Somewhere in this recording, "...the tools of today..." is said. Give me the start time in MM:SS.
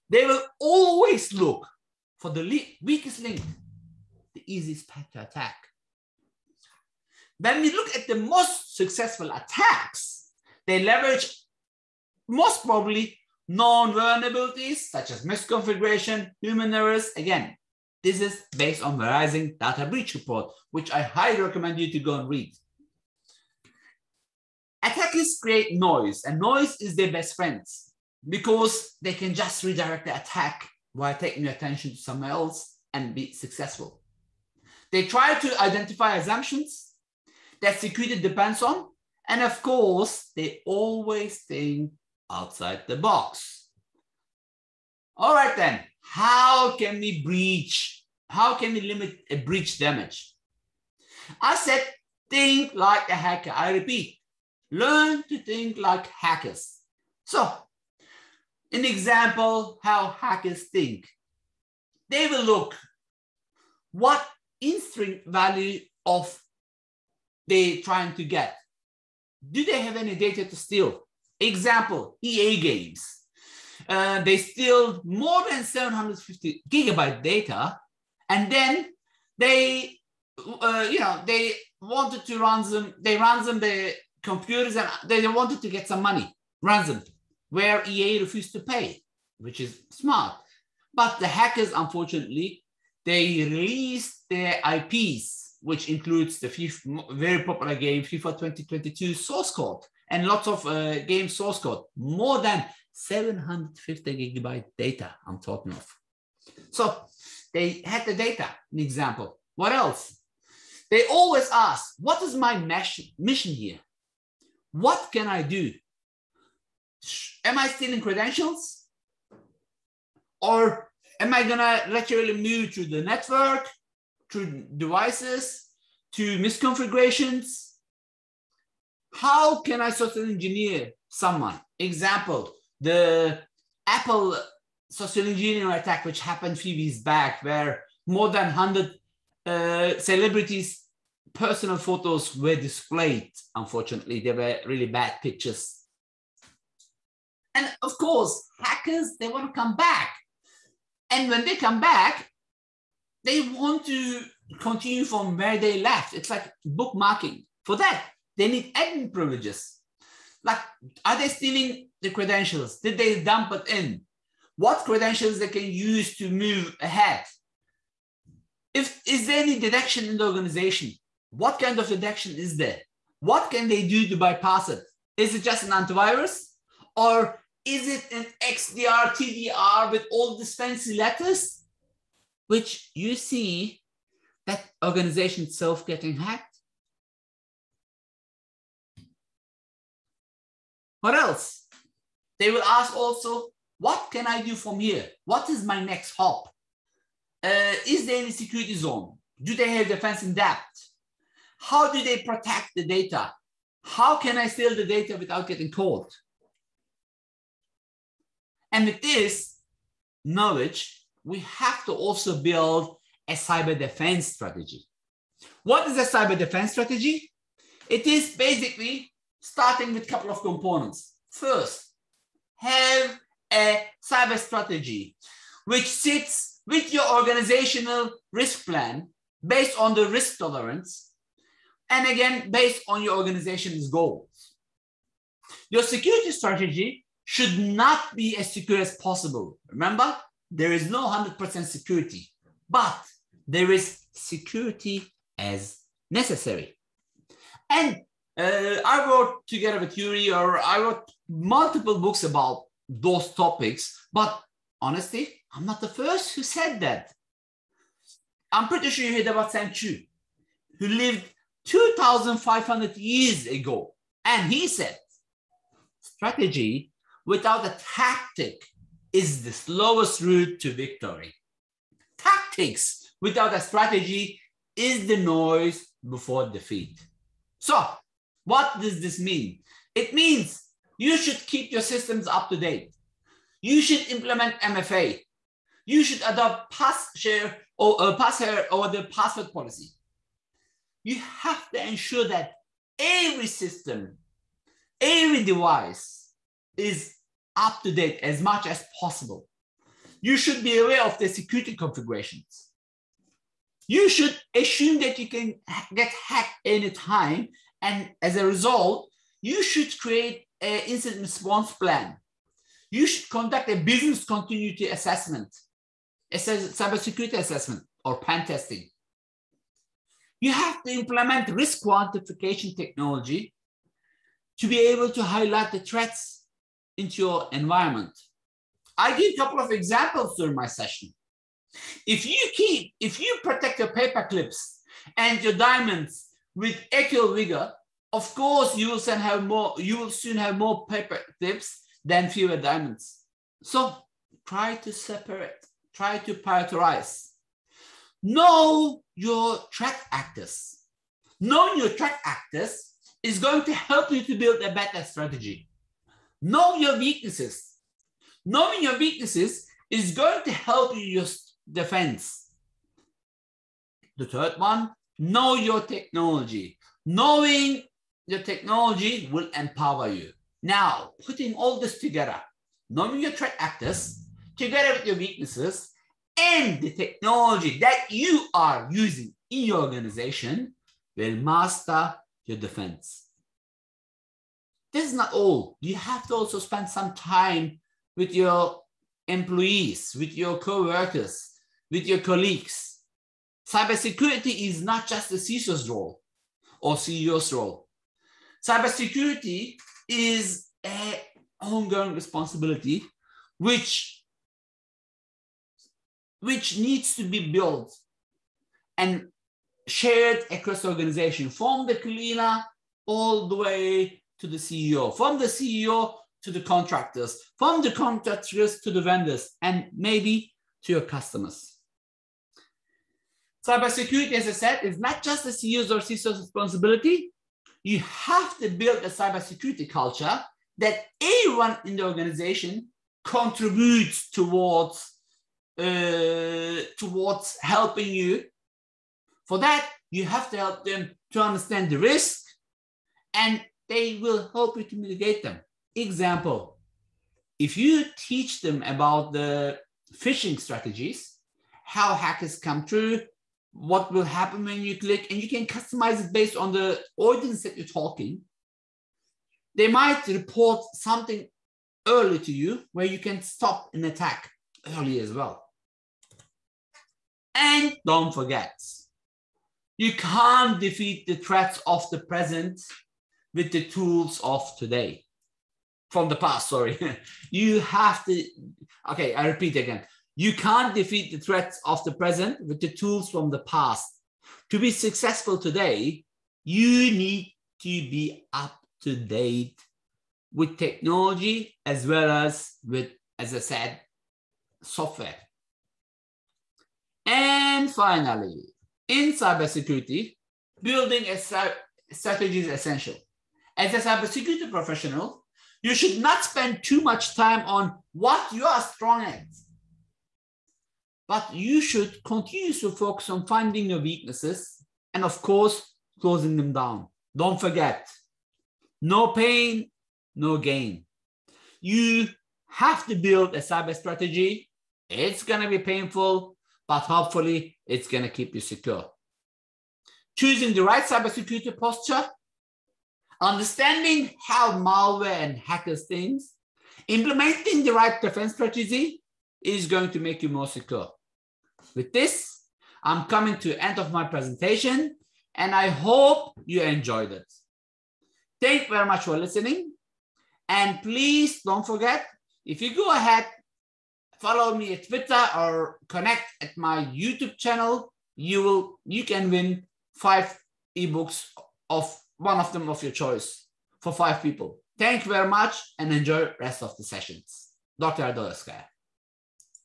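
07:53.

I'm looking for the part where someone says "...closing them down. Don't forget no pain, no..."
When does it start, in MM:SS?
08:36.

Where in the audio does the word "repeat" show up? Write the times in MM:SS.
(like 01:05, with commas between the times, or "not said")
00:53, 07:59.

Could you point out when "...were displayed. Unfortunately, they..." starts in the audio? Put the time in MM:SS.
02:22.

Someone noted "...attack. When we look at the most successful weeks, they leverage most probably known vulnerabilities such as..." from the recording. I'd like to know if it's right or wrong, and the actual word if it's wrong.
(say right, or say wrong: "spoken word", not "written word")
wrong: "attacks", not "weeks".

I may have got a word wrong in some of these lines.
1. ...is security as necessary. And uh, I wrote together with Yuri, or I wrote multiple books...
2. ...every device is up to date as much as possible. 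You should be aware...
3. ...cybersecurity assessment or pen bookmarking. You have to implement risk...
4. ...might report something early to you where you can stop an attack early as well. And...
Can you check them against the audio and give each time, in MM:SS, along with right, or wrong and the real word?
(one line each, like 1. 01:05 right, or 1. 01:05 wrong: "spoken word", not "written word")
1. 04:03 right
2. 04:55 right
3. 05:16 wrong: "testing", not "bookmarking"
4. 07:39 right.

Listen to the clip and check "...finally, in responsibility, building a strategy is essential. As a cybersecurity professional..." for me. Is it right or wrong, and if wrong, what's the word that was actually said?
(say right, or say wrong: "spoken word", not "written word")
wrong: "cybersecurity", not "responsibility".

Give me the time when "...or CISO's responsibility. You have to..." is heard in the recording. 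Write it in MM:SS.
07:05.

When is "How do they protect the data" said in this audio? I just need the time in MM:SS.
03:21.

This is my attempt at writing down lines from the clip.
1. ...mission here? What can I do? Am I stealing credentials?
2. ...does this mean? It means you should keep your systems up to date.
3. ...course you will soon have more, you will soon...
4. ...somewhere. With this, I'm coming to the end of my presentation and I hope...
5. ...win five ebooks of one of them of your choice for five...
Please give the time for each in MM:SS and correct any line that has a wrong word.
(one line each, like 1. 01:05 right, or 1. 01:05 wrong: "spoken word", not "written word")
1. 01:53 right
2. 04:38 right
3. 05:38 right
4. 09:00 wrong: "secure", not "somewhere"
5. 09:19 right.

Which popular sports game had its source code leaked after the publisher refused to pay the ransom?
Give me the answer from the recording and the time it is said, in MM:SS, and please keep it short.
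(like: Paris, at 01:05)
FIFA 2022, at 01:38.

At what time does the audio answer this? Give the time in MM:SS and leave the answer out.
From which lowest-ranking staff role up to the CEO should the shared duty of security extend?
06:51.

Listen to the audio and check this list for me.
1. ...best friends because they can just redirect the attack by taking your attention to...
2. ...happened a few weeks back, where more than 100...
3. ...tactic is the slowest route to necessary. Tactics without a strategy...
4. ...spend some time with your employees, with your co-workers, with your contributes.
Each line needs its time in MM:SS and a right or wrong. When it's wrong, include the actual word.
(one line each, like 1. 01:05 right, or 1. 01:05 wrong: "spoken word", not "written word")
1. 00:27 right
2. 02:16 right
3. 04:27 wrong: "victory", not "necessary"
4. 06:26 wrong: "colleagues", not "contributes".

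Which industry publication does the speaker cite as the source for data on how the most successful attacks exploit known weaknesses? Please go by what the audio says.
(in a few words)
Verizon data breach report.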